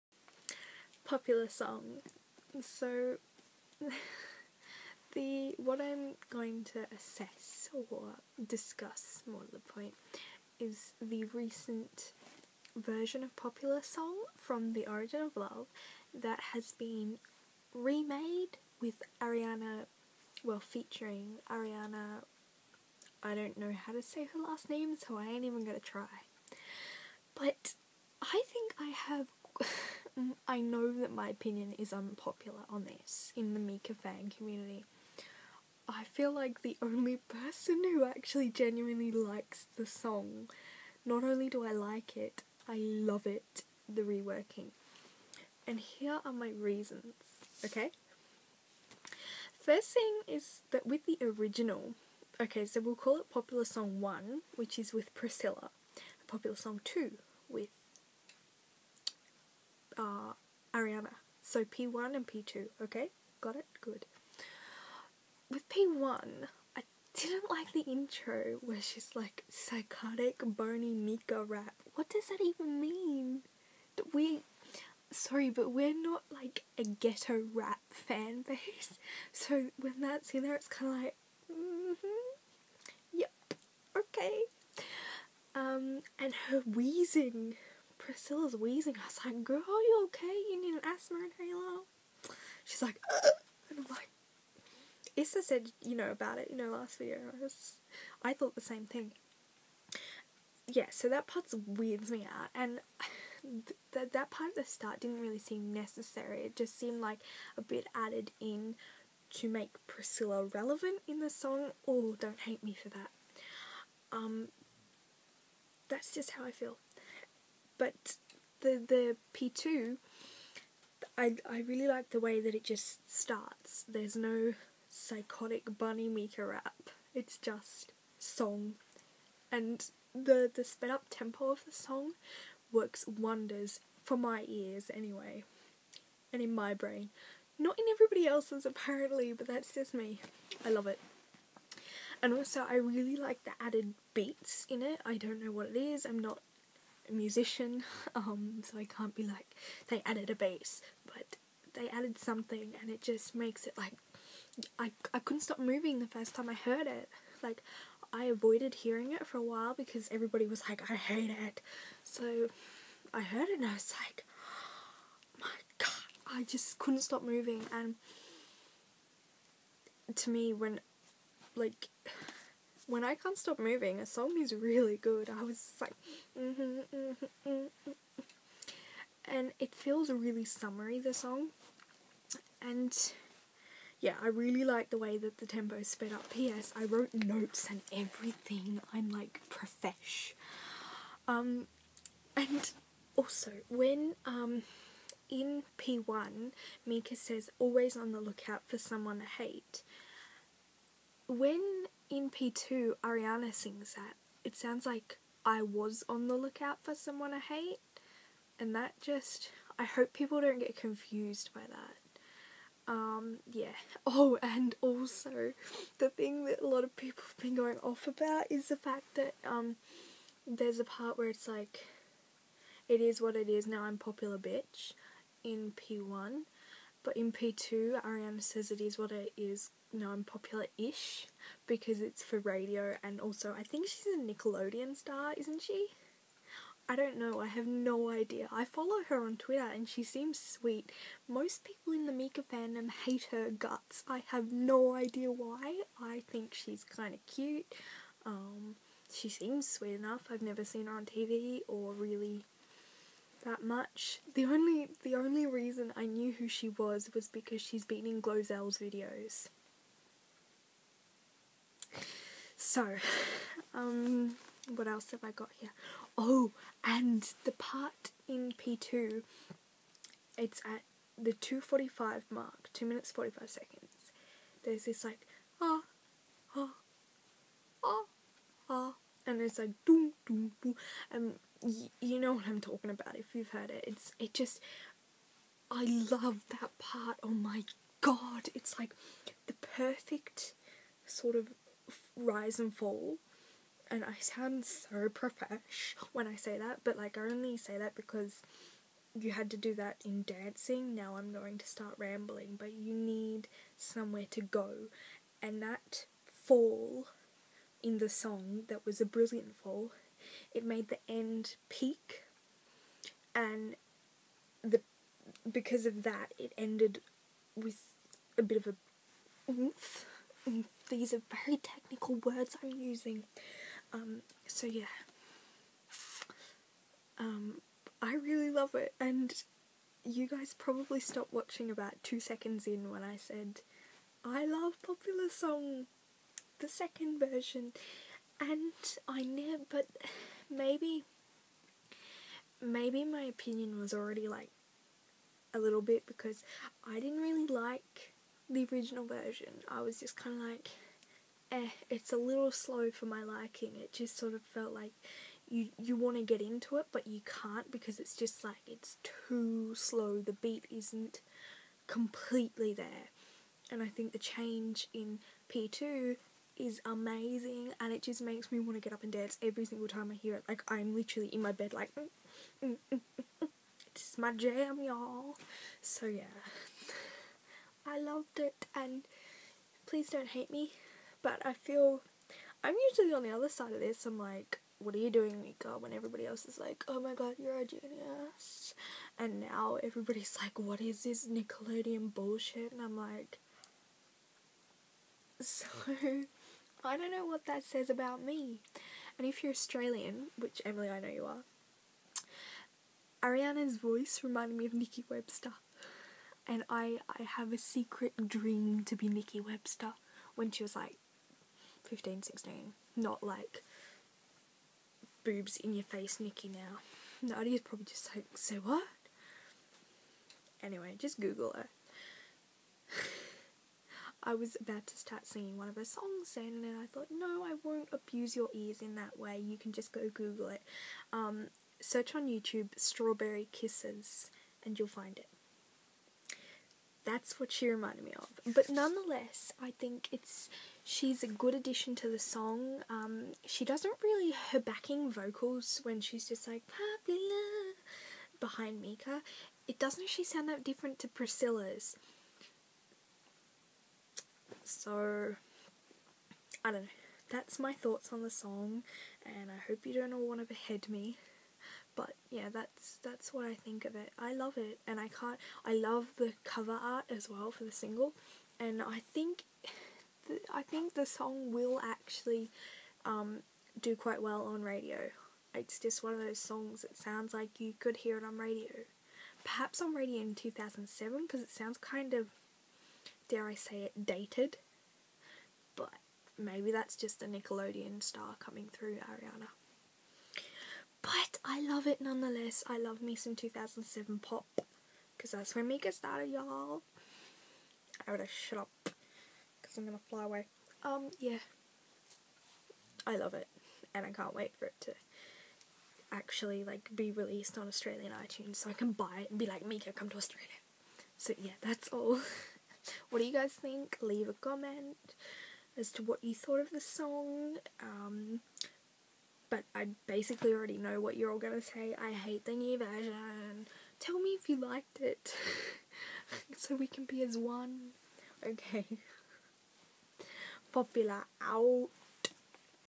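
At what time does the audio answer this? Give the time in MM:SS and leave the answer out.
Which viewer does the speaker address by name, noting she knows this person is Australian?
06:40.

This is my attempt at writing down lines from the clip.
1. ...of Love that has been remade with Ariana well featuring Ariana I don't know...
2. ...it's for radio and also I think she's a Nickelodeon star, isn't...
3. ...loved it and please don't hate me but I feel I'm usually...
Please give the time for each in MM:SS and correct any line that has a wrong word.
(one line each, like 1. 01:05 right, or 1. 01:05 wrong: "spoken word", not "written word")
1. 00:15 right
2. 03:52 right
3. 06:17 right.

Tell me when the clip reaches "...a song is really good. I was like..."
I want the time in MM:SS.
02:54.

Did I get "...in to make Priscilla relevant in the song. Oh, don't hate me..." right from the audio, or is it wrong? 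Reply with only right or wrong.
right.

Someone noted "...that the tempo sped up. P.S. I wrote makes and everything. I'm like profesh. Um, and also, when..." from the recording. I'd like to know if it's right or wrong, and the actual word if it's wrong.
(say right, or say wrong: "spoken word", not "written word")
wrong: "notes", not "makes".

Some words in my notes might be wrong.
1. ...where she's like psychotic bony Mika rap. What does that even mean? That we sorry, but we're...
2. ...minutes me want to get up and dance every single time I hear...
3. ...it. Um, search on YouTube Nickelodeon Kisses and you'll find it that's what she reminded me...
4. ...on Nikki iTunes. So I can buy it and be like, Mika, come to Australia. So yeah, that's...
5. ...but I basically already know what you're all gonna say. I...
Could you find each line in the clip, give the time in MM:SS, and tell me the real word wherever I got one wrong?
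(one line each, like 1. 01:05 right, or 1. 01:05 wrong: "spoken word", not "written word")
1. 01:08 right
2. 06:08 wrong: "makes", not "minutes"
3. 07:10 wrong: "Strawberry", not "Nickelodeon"
4. 08:27 wrong: "Australian", not "Nikki"
5. 08:39 right.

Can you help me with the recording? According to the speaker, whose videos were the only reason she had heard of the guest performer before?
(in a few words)
Glozell's.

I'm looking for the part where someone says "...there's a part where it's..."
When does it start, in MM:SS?
03:40.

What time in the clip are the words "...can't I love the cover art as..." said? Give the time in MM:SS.
07:45.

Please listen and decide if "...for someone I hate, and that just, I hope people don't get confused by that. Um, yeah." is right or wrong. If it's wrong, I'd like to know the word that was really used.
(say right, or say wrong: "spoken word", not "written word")
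right.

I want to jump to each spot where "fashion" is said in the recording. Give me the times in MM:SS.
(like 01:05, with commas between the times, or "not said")
not said.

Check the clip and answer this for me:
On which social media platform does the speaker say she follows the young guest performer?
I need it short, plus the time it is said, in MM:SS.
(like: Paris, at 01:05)
Twitter, at 03:59.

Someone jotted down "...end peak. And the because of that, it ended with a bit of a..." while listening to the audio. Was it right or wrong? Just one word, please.
right.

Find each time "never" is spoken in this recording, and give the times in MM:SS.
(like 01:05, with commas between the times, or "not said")
04:10, 05:39.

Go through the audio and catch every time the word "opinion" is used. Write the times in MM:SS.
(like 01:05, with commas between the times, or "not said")
00:31, 05:43.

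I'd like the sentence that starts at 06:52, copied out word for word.
Not like boobs in your face Nikki now.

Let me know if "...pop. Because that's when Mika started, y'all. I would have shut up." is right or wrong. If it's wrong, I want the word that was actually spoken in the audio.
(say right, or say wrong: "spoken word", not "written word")
right.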